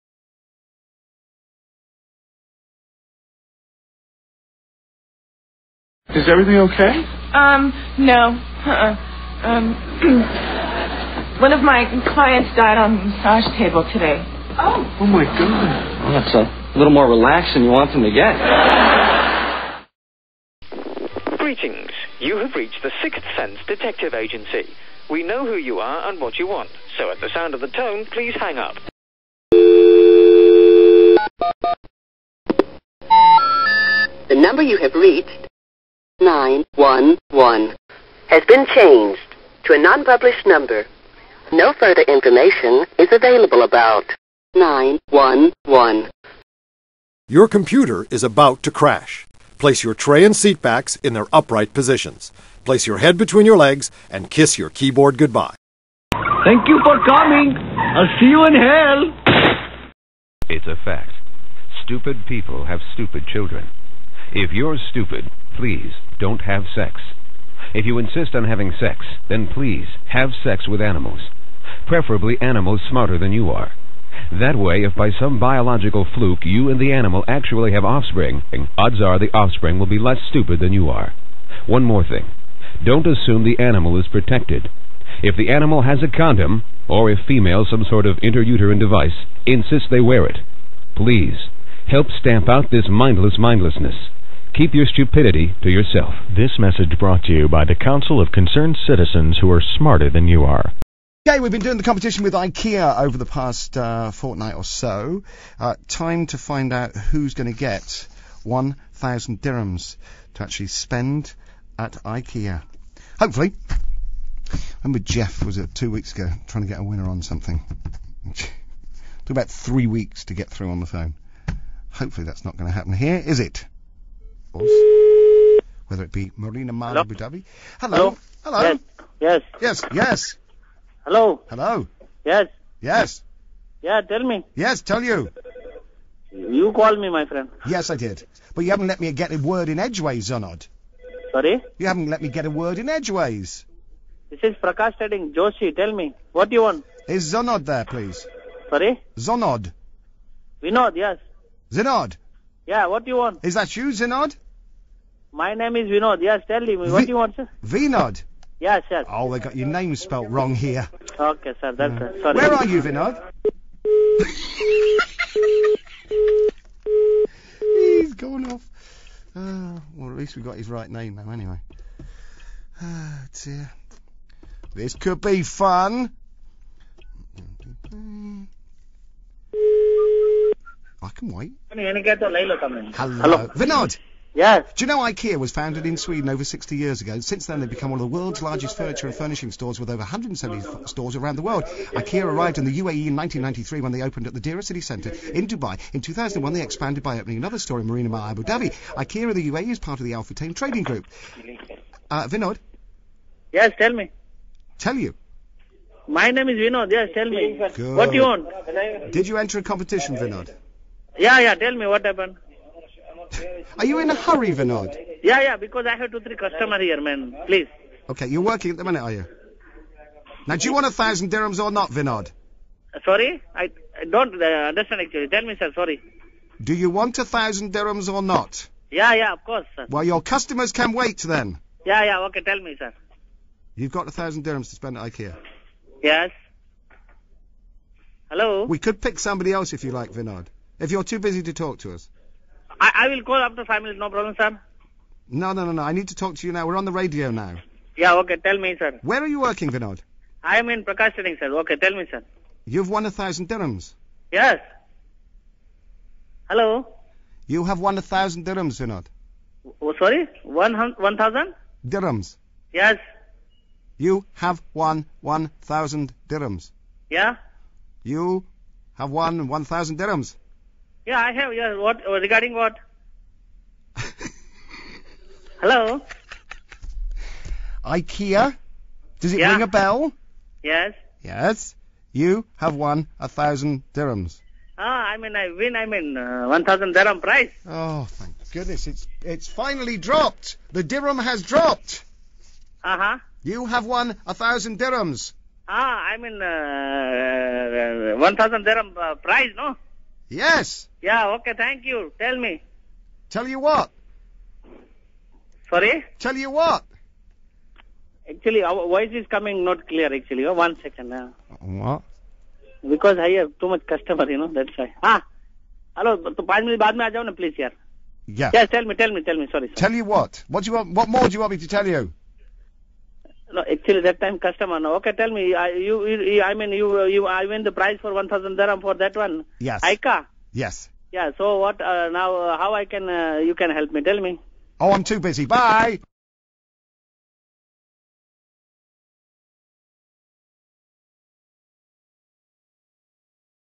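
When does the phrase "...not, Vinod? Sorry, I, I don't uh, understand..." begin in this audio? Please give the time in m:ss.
3:41.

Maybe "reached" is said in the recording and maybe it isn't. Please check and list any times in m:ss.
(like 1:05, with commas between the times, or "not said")
0:22, 0:34.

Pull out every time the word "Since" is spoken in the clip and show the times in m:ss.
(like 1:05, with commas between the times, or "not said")
3:07.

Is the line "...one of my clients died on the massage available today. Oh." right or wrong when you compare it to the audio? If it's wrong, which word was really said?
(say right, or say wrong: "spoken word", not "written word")
wrong: "table", not "available".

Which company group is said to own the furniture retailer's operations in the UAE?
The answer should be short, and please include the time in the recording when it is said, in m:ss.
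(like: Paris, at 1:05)
Al-Futtaim Trading Group, at 3:20.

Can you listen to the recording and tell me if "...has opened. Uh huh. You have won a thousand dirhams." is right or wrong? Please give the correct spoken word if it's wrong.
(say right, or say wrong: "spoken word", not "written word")
wrong: "dropped", not "opened".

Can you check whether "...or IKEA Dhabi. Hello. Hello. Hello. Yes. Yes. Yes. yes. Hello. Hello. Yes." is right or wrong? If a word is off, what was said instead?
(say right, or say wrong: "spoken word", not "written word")
wrong: "Abu", not "IKEA".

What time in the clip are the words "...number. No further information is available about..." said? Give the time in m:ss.
0:40.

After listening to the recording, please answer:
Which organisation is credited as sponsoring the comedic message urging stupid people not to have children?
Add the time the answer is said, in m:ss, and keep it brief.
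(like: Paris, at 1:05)
Council of Concerned Citizens, at 1:37.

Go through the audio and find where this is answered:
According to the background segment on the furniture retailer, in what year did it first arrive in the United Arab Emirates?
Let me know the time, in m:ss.
3:13.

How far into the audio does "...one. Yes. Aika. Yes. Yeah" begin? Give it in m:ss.
5:29.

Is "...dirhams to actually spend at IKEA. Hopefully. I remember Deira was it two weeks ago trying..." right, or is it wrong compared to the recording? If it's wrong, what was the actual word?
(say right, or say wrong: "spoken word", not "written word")
wrong: "Jeff", not "Deira".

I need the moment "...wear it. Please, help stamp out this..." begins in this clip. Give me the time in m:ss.
1:29.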